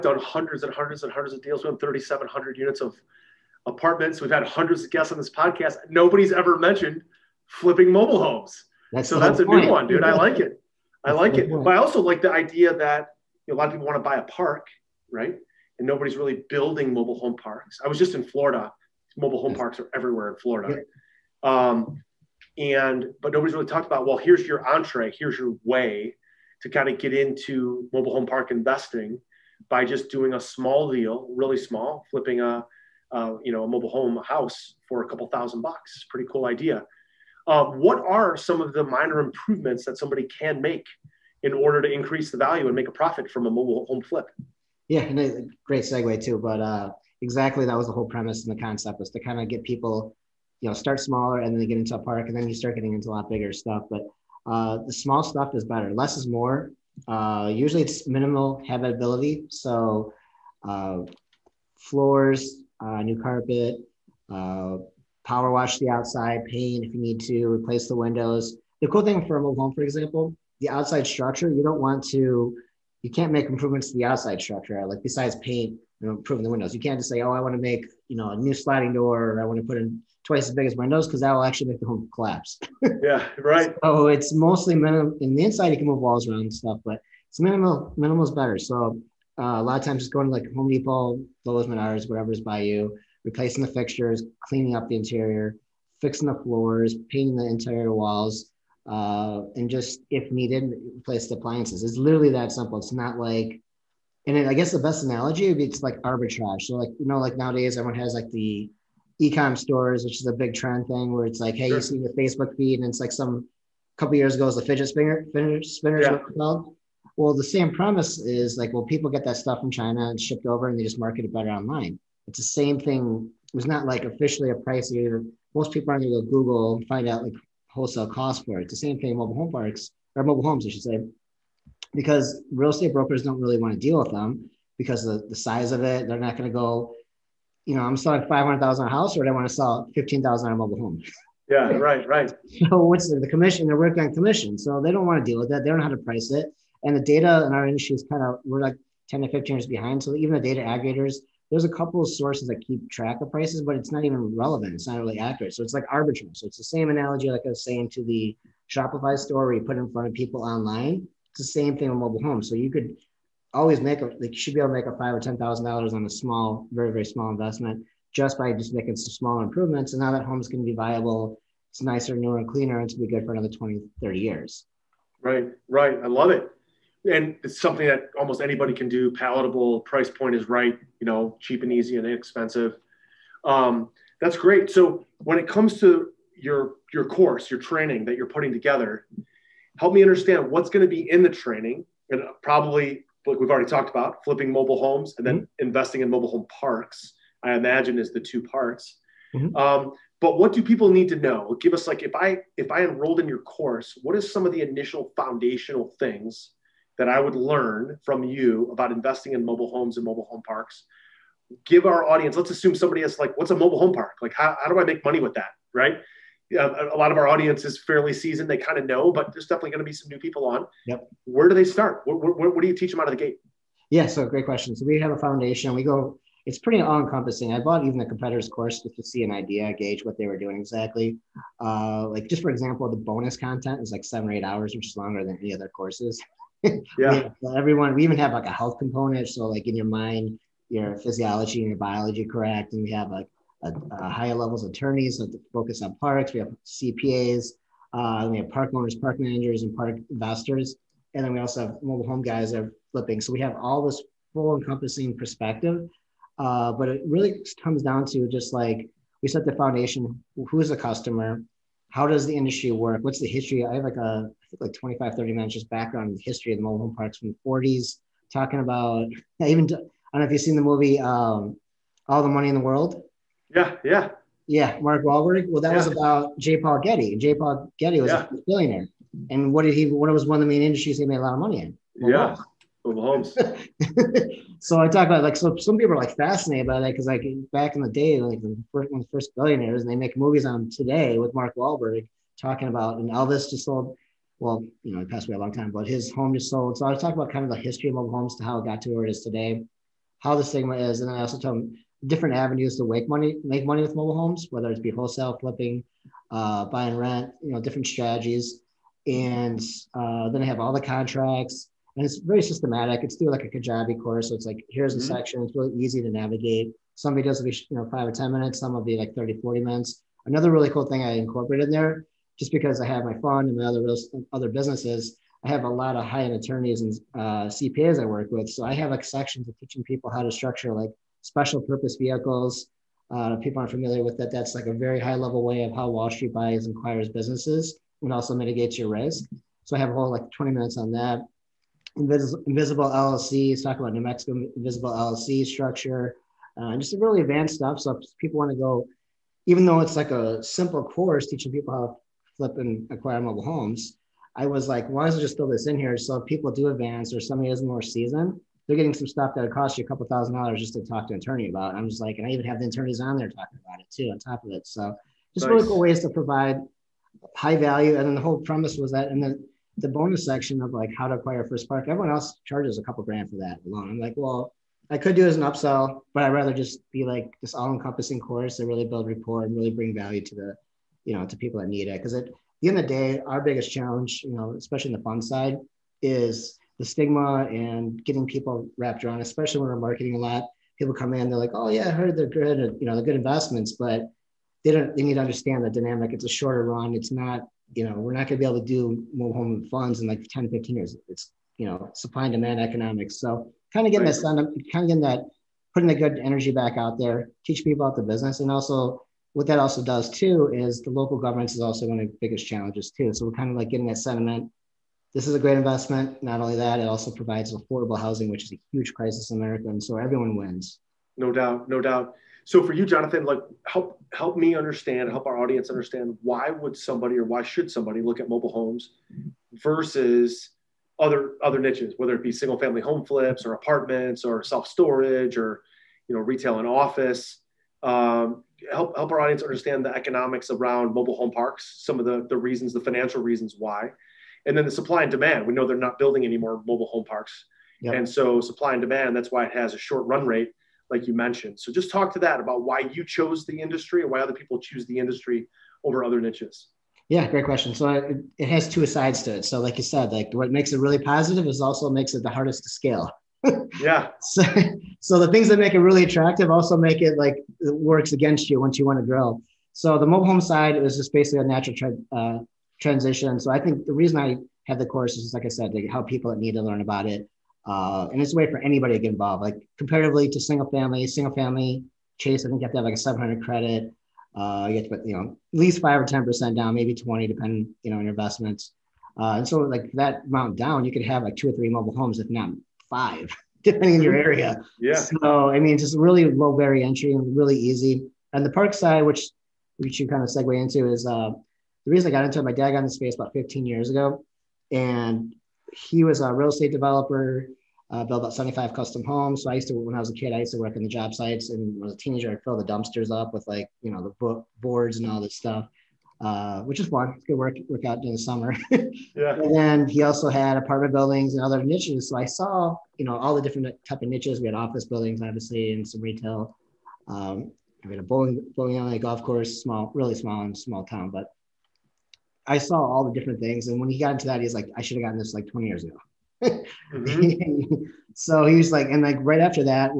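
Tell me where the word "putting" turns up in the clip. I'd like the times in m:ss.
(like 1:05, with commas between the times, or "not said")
3:08, 6:45.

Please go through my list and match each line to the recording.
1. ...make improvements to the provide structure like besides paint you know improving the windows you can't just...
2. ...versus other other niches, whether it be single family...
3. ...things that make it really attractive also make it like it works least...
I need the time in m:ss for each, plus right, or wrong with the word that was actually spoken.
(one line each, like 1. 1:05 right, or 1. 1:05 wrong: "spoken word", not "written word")
1. 1:13 wrong: "outside", not "provide"
2. 7:09 right
3. 7:45 wrong: "against", not "least".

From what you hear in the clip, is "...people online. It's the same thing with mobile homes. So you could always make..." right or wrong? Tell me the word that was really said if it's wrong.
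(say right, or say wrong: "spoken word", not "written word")
right.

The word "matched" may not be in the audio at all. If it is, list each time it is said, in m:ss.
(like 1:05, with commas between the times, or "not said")
not said.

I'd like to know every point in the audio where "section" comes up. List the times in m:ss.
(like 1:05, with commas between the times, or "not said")
5:15, 5:29, 6:10.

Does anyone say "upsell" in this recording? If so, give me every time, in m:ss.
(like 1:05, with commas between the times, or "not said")
6:15.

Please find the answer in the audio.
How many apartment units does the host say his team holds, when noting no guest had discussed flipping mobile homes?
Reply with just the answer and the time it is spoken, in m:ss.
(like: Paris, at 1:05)
3,700, at 0:01.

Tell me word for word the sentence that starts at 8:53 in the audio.
And when he got into that, he's like, I should have gotten this like 20 years ago.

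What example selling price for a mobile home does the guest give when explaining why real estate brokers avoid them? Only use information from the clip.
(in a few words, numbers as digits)
15,000.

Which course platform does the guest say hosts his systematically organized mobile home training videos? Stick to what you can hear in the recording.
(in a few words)
Kajabi.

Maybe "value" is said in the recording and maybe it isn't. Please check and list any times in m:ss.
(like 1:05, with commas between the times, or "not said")
0:42, 6:07, 6:19.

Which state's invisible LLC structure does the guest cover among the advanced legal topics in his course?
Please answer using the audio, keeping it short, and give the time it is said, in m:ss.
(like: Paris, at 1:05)
New Mexico, at 5:43.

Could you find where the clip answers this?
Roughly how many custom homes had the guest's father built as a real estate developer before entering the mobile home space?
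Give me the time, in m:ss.
8:28.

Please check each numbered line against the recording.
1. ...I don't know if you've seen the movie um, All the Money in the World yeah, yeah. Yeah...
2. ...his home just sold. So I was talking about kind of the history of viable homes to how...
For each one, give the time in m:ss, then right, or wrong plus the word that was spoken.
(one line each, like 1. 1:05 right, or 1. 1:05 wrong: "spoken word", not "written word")
1. 4:29 right
2. 4:55 wrong: "mobile", not "viable".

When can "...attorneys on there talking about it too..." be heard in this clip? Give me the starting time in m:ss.
6:02.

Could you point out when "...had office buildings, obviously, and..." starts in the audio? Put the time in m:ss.
8:44.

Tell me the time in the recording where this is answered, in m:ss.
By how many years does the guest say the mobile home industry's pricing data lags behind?
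2:29.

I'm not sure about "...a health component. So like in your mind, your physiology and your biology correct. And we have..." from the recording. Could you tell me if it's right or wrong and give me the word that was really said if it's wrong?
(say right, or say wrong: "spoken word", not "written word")
right.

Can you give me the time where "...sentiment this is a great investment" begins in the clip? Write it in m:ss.
6:53.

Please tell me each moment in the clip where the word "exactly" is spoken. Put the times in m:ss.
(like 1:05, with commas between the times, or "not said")
0:47, 3:50.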